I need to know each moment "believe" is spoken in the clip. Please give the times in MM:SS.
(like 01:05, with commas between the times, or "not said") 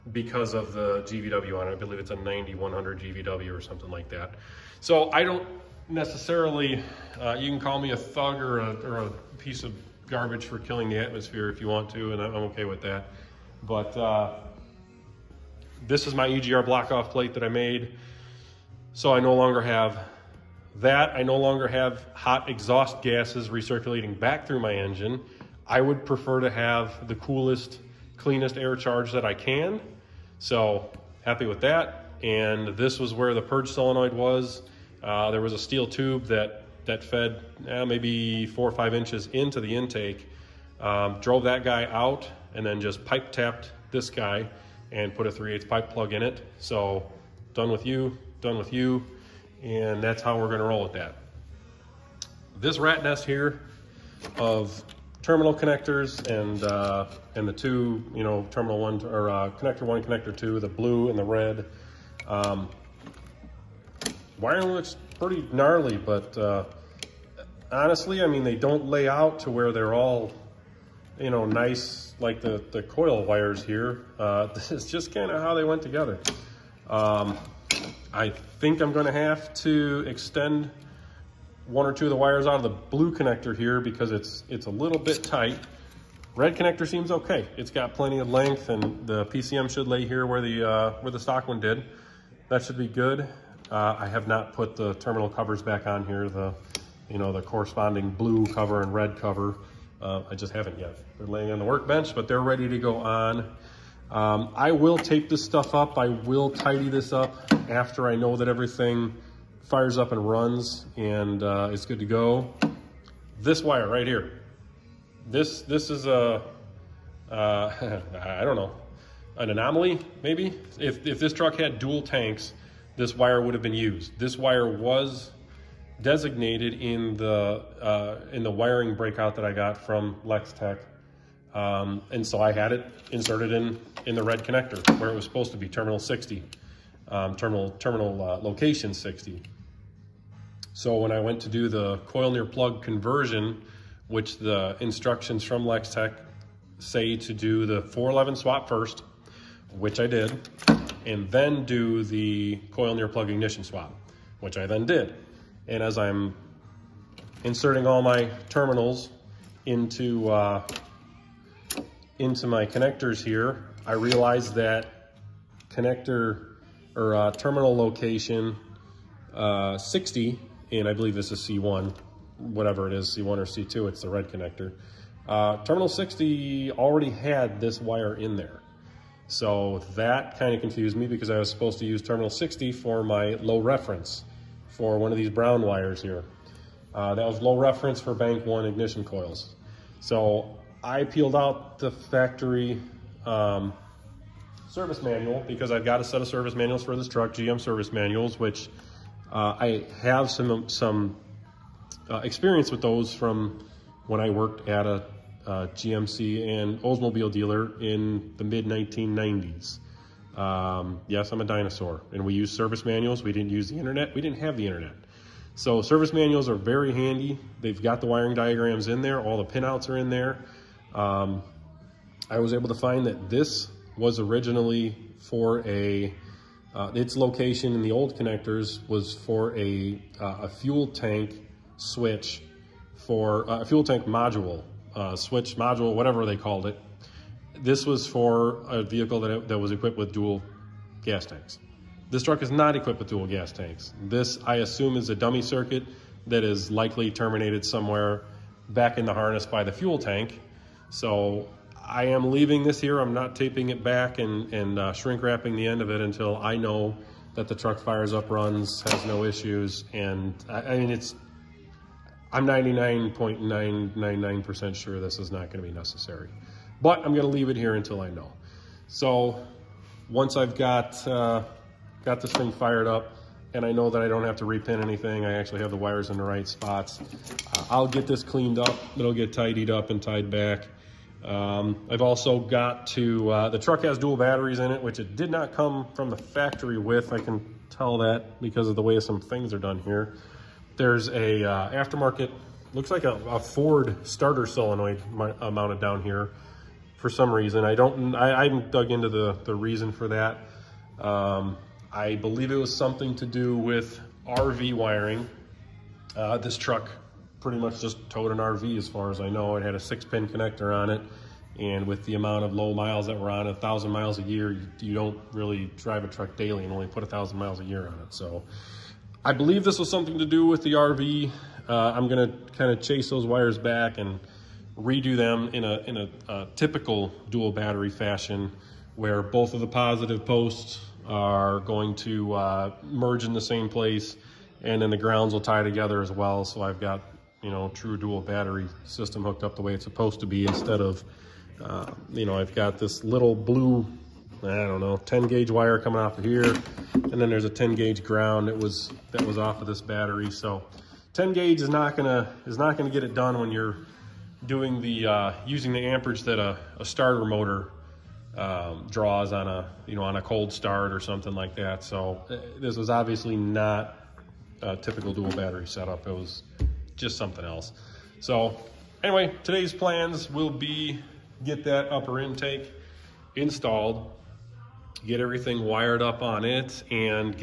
00:01, 02:50, 05:02, 05:19.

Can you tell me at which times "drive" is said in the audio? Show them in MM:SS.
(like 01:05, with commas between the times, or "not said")
05:15.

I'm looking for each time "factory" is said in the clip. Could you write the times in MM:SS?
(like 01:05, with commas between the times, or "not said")
03:11, 04:46.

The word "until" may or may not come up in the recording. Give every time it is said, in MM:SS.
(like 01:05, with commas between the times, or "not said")
04:15, 04:27.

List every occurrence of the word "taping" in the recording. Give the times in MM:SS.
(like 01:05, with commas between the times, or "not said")
04:13.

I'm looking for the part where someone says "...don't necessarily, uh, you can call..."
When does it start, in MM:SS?
00:05.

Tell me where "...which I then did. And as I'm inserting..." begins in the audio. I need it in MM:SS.
02:34.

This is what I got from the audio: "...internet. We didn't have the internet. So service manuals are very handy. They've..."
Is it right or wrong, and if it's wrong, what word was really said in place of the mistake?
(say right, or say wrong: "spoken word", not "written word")
right.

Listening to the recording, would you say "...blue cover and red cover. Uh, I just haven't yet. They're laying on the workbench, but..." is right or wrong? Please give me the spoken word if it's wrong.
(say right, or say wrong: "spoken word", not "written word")
right.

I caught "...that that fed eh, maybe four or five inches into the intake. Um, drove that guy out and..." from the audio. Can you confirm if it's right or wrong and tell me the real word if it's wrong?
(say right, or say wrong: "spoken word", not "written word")
right.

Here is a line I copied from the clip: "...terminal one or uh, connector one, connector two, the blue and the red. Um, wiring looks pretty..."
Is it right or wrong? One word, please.
right.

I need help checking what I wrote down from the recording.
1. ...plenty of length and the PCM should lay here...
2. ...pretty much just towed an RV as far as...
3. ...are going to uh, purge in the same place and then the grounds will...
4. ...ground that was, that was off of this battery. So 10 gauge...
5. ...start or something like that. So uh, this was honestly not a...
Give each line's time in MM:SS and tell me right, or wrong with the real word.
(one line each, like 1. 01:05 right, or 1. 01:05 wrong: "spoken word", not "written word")
1. 01:27 right
2. 05:07 right
3. 05:31 wrong: "merge", not "purge"
4. 05:48 right
5. 06:00 wrong: "obviously", not "honestly".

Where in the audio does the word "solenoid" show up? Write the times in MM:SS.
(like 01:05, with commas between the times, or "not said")
00:33, 04:54.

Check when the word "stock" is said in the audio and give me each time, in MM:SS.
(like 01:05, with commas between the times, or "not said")
01:31.